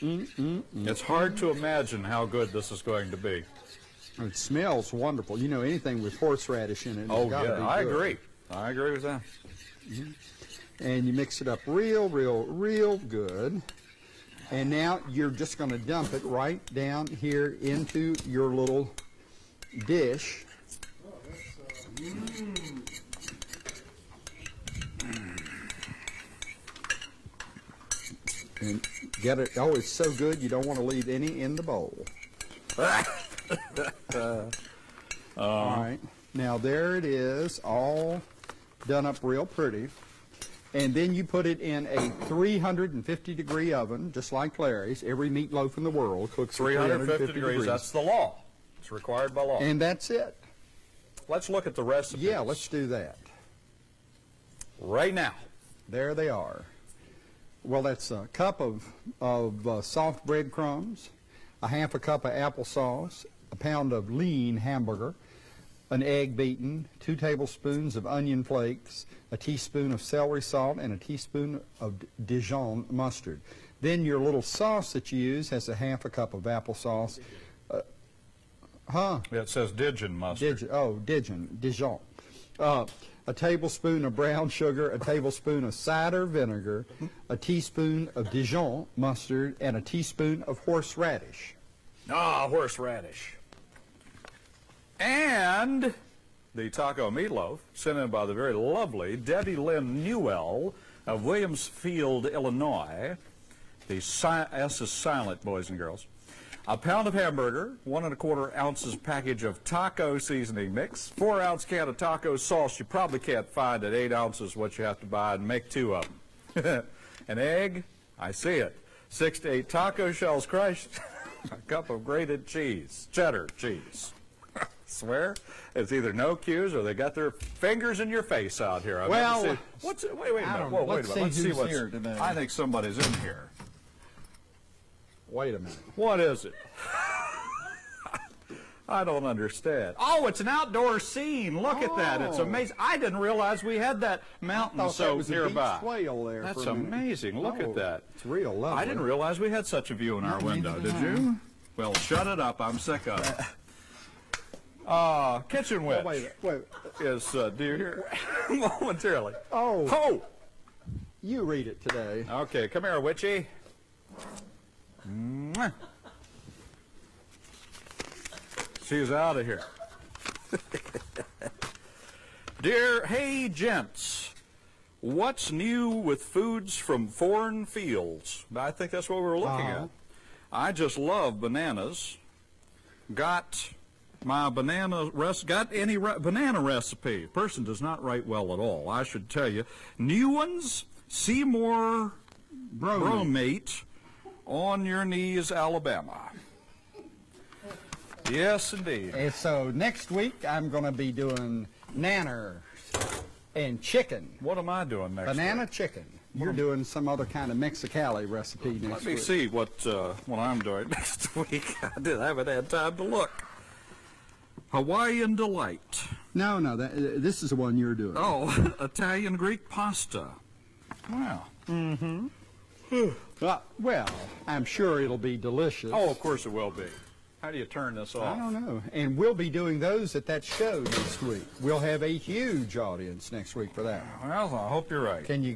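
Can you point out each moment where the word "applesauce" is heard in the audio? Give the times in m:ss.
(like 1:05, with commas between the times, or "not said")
1:02, 1:16.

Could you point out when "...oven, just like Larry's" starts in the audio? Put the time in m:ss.
0:43.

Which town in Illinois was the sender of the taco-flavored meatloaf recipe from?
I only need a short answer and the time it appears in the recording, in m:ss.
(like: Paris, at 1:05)
Williamsfield, at 1:41.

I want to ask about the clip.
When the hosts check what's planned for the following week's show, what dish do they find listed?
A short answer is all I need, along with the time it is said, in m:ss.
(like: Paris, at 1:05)
Italian Greek pasta, at 3:38.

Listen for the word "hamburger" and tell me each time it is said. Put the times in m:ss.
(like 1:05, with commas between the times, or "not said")
1:04, 1:47.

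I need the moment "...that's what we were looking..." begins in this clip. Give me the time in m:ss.
2:58.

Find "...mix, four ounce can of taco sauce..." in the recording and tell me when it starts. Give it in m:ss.
1:50.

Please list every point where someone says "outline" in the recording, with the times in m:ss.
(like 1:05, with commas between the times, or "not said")
not said.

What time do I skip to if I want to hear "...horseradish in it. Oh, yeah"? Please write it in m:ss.
0:06.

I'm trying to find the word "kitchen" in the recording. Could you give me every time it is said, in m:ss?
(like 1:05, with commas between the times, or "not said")
2:35.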